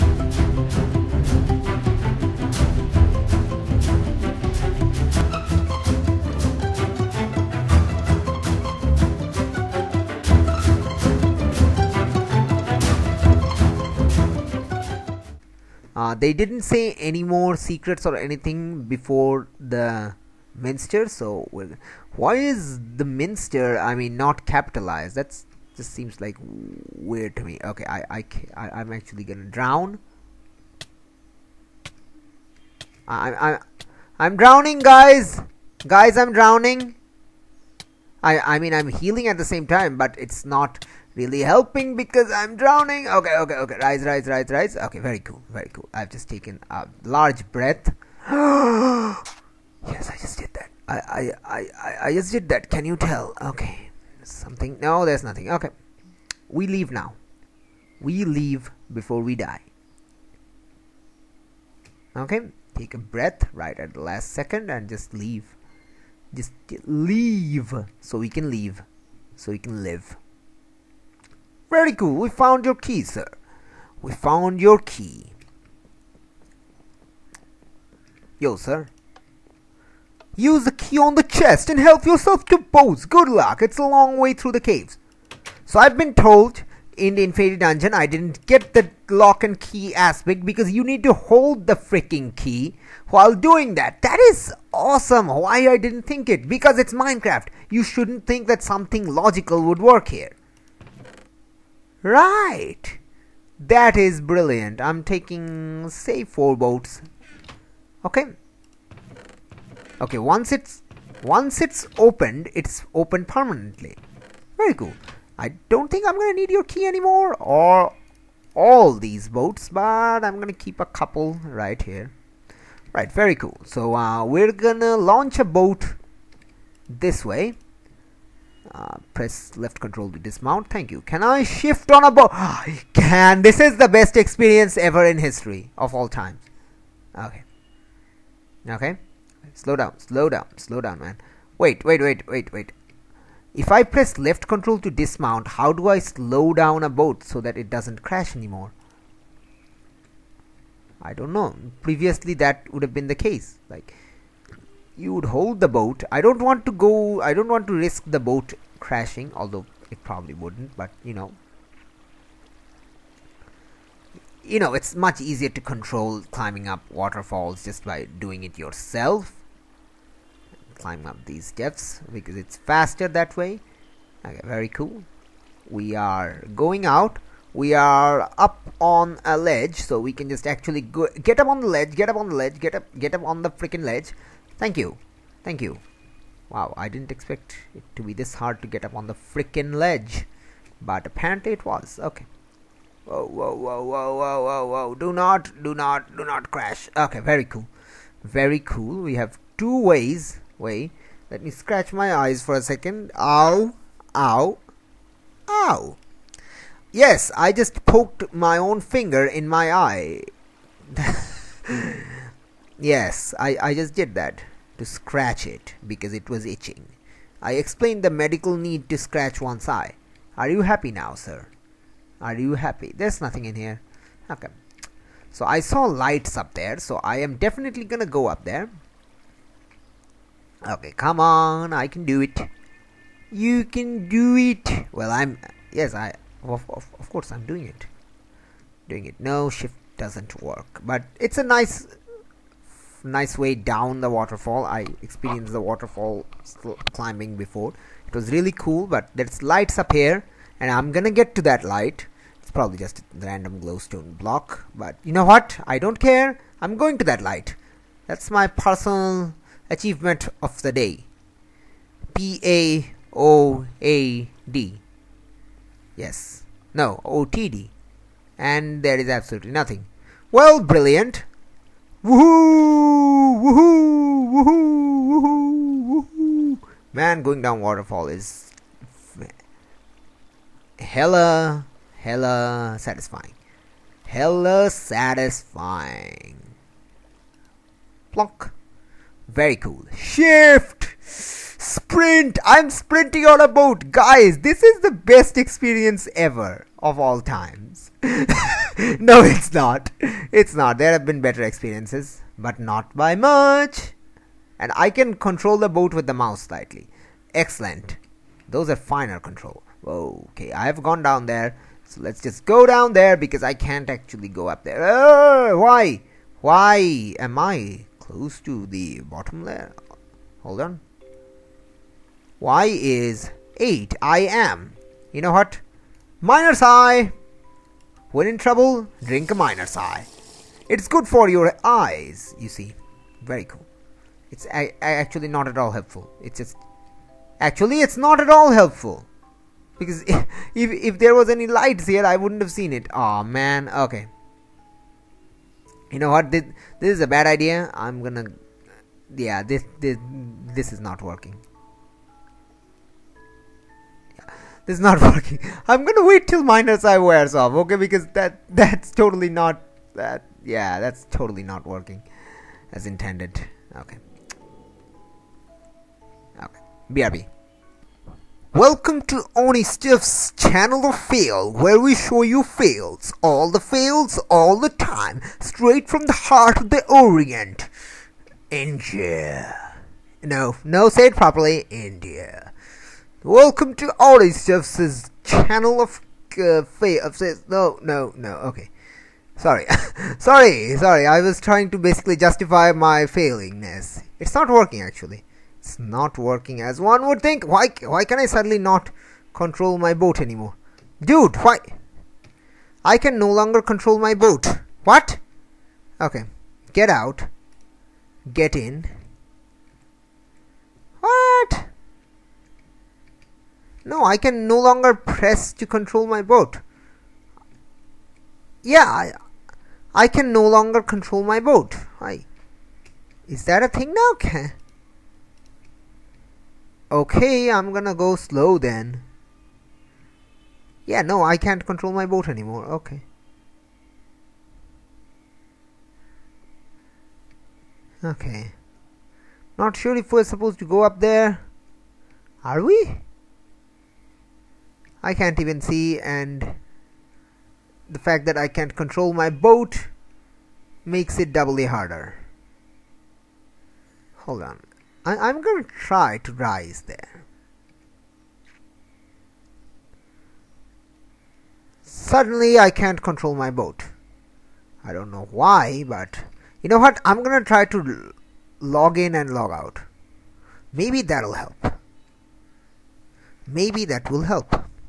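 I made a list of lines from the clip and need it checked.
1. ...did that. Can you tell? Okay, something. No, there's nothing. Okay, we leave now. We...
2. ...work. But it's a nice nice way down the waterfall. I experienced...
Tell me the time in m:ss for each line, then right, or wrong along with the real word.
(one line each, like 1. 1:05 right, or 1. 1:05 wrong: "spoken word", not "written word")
1. 0:52 right
2. 4:00 right.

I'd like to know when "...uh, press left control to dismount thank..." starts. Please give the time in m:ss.
2:08.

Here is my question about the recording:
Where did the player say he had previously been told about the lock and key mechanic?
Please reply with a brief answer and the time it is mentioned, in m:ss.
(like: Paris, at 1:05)
Infinity Dungeon, at 1:27.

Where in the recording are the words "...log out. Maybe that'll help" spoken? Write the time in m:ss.
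7:49.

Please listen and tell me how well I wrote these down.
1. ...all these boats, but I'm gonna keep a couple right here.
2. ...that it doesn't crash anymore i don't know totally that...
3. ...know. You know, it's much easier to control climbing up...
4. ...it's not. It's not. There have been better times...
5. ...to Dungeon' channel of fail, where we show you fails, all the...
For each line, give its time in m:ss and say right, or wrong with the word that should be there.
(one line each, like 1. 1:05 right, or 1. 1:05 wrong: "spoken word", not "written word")
1. 1:58 right
2. 2:27 wrong: "previously", not "totally"
3. 2:41 right
4. 4:59 wrong: "experiences", not "times"
5. 6:09 wrong: "Anistuffs", not "Dungeon".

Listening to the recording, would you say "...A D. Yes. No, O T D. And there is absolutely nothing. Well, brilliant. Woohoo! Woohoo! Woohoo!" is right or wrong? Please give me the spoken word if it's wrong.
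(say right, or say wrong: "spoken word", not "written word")
right.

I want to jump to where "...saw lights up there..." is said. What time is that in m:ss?
3:45.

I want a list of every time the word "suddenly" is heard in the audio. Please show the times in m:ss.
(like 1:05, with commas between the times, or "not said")
6:38, 7:41.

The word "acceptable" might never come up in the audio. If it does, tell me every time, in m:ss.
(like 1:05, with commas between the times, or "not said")
not said.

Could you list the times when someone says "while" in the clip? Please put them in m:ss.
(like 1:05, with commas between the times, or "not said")
1:33.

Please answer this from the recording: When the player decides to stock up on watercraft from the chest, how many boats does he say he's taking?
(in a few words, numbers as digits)
4.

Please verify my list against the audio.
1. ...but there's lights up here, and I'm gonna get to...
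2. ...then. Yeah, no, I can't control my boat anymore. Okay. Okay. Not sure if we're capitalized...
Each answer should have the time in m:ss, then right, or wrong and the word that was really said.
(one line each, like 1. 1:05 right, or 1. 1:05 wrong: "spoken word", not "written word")
1. 4:08 right
2. 7:08 wrong: "supposed", not "capitalized".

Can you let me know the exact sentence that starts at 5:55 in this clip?
I'm gonna wait till minus I wears off, okay?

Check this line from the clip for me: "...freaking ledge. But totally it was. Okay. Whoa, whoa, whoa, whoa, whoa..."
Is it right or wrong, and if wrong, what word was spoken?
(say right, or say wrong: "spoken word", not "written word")
wrong: "apparently", not "totally".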